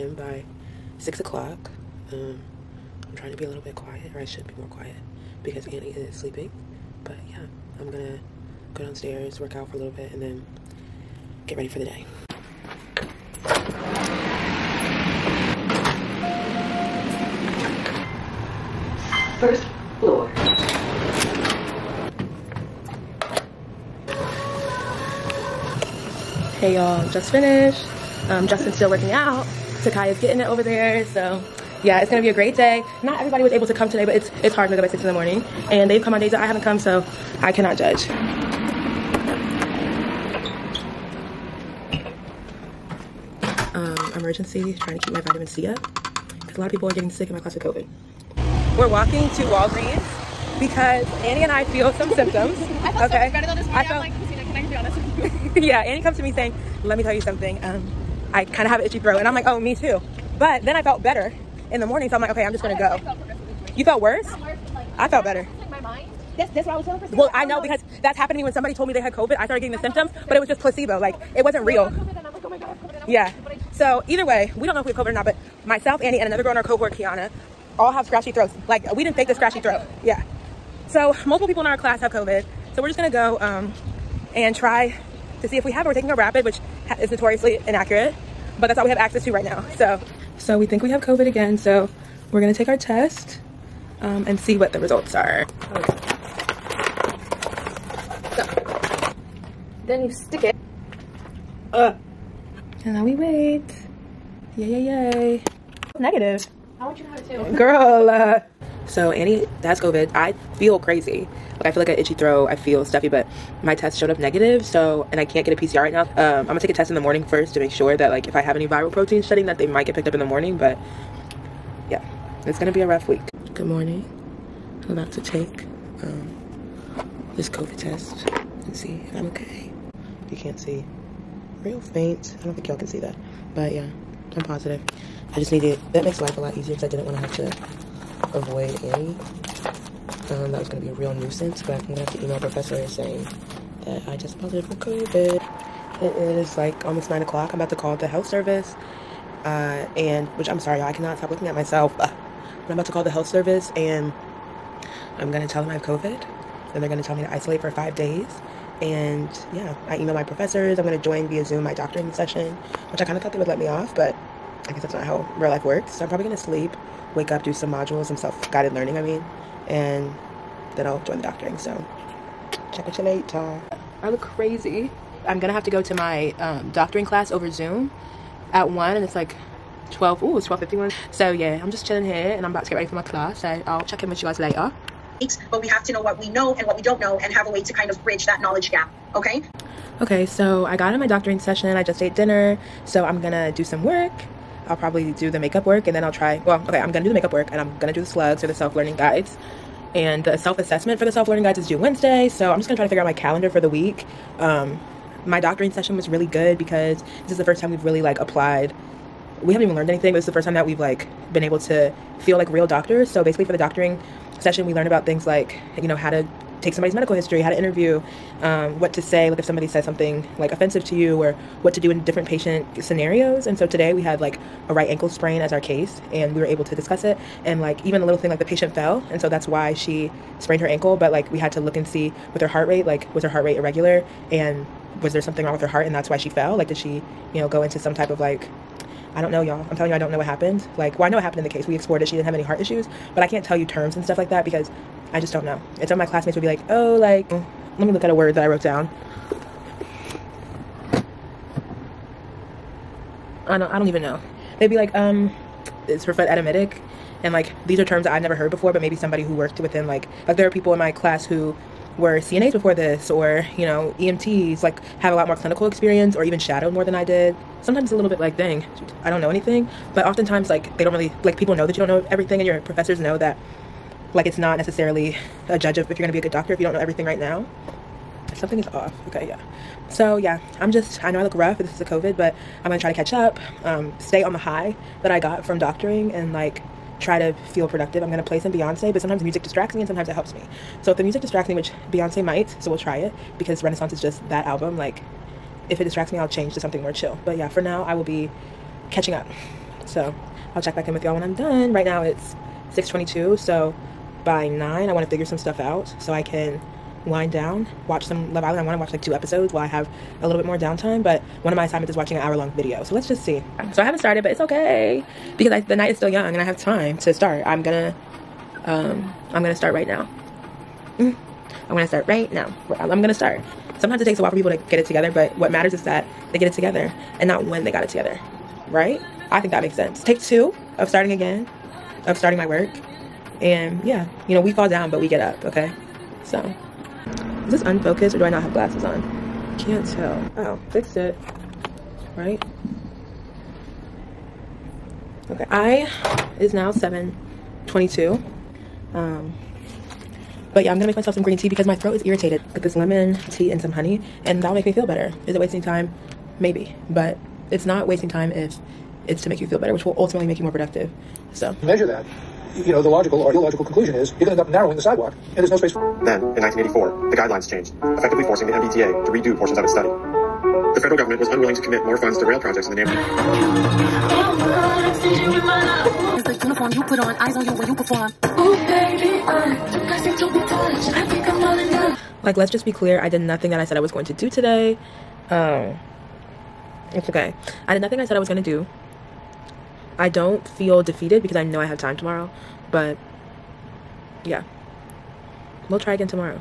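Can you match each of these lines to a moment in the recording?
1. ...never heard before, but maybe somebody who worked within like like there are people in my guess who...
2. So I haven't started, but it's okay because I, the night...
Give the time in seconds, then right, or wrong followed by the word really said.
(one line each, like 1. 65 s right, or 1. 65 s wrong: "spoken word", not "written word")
1. 258 s wrong: "class", not "guess"
2. 313 s right.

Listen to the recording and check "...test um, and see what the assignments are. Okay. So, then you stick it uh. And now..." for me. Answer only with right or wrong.
wrong.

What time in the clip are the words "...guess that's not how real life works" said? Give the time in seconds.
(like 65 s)
164 s.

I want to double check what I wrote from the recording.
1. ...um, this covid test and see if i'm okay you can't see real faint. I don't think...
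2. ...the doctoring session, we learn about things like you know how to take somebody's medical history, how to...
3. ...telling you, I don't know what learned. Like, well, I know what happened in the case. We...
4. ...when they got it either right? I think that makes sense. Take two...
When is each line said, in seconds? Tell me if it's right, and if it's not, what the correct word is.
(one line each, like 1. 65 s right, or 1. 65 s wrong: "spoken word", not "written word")
1. 126 s right
2. 213 s right
3. 239 s wrong: "happened", not "learned"
4. 327 s wrong: "together", not "either".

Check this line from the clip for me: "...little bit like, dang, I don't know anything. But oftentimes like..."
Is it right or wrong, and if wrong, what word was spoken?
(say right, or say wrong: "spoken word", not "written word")
right.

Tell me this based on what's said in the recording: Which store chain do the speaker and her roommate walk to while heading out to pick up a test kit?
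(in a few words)
Walgreens.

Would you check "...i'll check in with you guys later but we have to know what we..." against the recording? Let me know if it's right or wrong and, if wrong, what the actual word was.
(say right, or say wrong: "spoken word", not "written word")
right.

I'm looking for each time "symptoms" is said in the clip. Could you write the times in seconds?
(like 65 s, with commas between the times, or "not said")
52 s, 69 s.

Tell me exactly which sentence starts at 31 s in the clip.
So yeah, it's gonna be a great day.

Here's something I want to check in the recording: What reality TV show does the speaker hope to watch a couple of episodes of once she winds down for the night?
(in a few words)
Love Island.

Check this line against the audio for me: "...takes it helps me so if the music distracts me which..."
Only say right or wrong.
wrong.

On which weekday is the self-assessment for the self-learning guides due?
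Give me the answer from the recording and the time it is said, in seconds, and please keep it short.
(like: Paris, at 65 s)
Wednesday, at 201 s.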